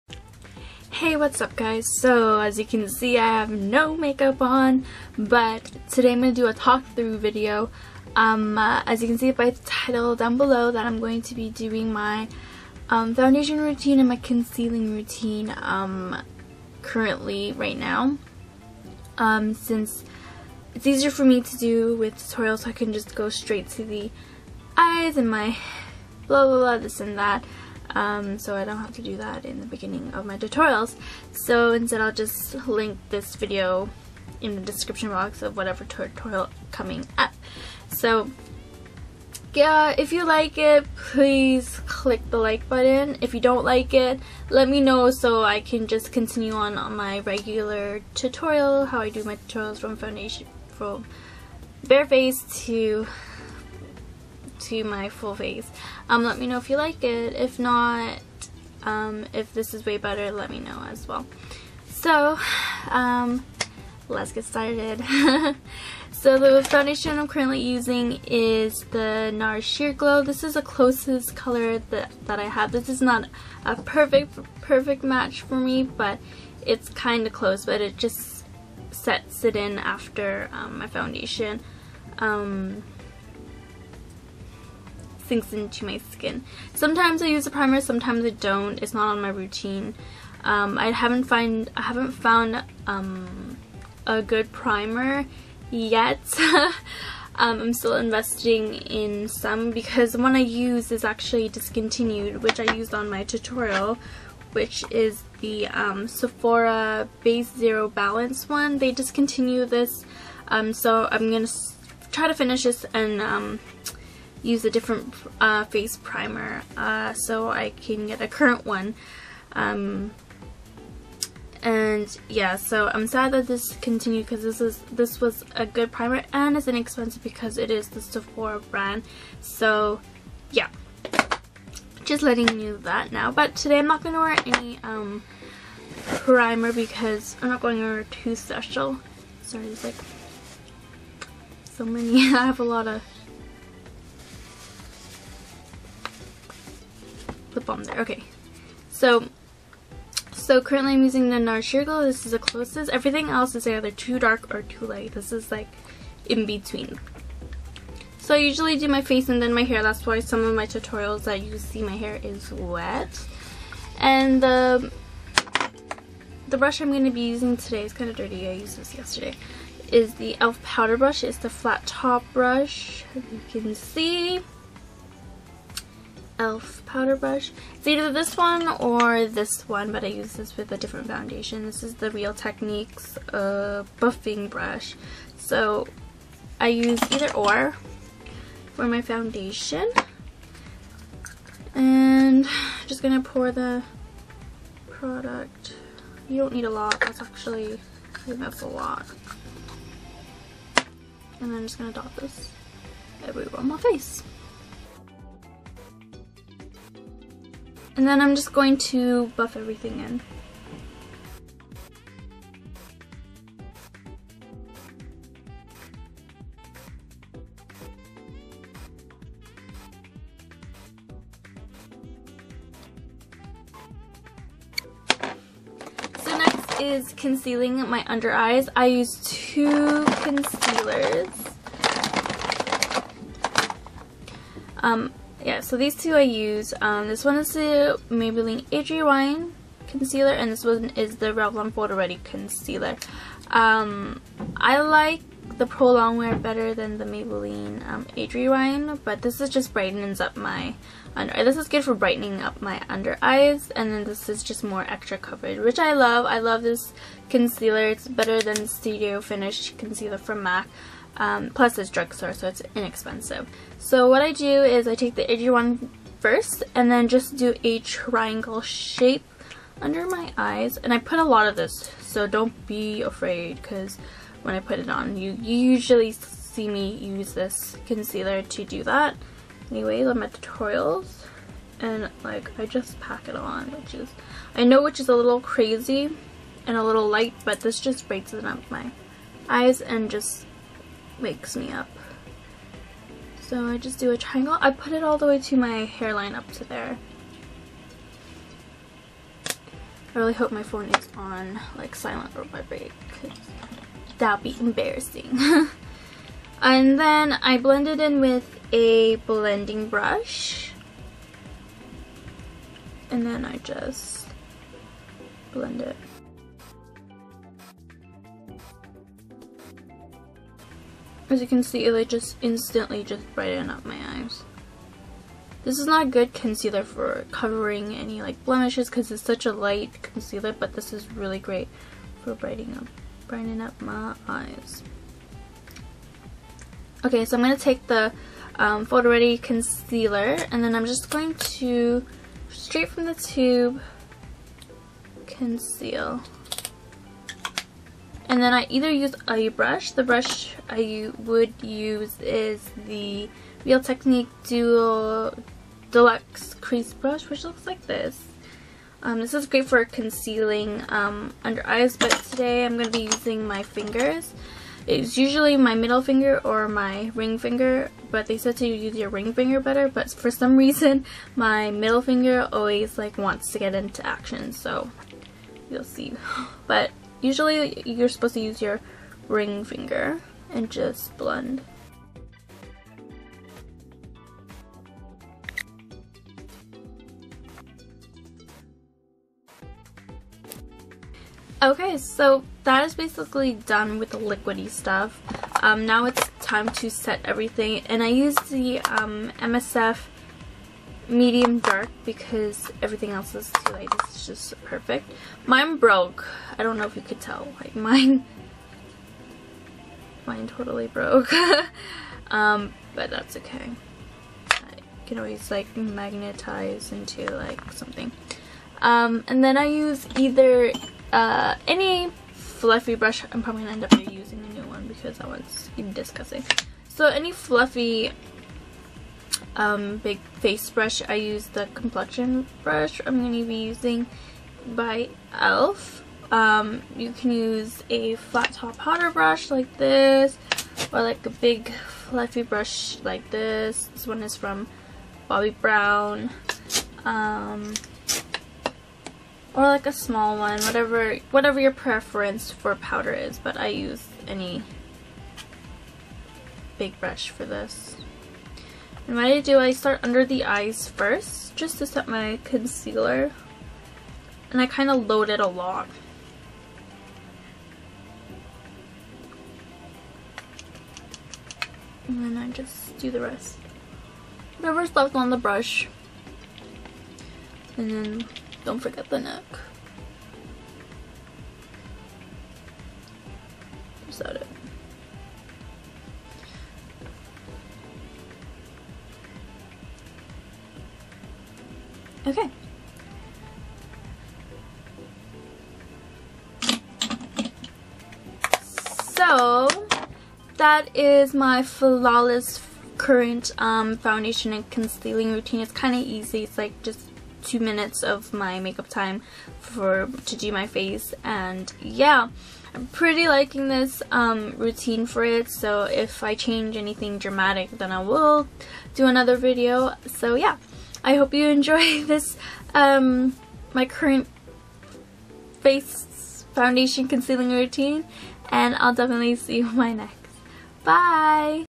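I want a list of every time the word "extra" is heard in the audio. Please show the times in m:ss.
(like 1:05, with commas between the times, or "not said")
4:14.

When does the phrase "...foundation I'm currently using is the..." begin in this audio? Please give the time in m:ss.
1:06.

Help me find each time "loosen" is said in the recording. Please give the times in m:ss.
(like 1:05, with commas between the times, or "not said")
not said.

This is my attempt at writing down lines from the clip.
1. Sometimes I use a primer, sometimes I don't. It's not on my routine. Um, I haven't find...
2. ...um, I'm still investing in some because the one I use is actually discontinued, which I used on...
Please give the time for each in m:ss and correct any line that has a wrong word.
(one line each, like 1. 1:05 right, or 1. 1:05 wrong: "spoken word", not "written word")
1. 1:26 right
2. 1:37 right.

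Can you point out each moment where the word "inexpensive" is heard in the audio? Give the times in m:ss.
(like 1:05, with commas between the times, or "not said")
2:06, 4:22.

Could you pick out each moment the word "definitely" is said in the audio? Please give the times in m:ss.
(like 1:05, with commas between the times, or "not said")
8:48.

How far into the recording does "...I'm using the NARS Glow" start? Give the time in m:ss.
2:30.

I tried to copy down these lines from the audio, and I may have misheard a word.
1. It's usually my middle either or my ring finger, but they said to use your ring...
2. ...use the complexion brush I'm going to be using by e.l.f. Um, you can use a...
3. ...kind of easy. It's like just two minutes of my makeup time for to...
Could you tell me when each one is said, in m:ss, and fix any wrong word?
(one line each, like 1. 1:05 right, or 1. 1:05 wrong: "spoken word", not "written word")
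1. 6:04 wrong: "finger", not "either"
2. 7:11 right
3. 8:25 right.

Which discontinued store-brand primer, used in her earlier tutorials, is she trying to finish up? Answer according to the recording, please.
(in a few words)
Sephora Base Zero Balance.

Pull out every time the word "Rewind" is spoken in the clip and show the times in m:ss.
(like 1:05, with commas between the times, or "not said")
3:58, 4:08.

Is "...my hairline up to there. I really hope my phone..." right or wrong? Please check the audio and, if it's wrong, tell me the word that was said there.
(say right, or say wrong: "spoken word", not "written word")
right.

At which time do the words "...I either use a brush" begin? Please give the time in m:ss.
5:48.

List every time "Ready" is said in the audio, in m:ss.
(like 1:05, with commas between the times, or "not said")
4:01, 5:39.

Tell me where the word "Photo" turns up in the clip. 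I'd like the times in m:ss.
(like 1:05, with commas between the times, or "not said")
4:01, 5:38.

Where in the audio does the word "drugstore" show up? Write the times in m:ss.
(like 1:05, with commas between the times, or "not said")
4:21.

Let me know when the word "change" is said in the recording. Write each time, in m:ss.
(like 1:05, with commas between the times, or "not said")
8:36.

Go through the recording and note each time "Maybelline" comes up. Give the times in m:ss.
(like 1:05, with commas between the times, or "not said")
3:58, 4:07.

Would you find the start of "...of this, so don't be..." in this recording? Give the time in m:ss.
4:31.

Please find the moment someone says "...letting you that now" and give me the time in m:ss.
2:12.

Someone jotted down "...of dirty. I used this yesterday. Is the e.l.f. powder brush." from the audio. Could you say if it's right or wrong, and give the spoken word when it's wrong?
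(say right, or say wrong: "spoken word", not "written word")
right.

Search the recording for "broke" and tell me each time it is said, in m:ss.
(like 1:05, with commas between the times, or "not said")
6:45, 6:50.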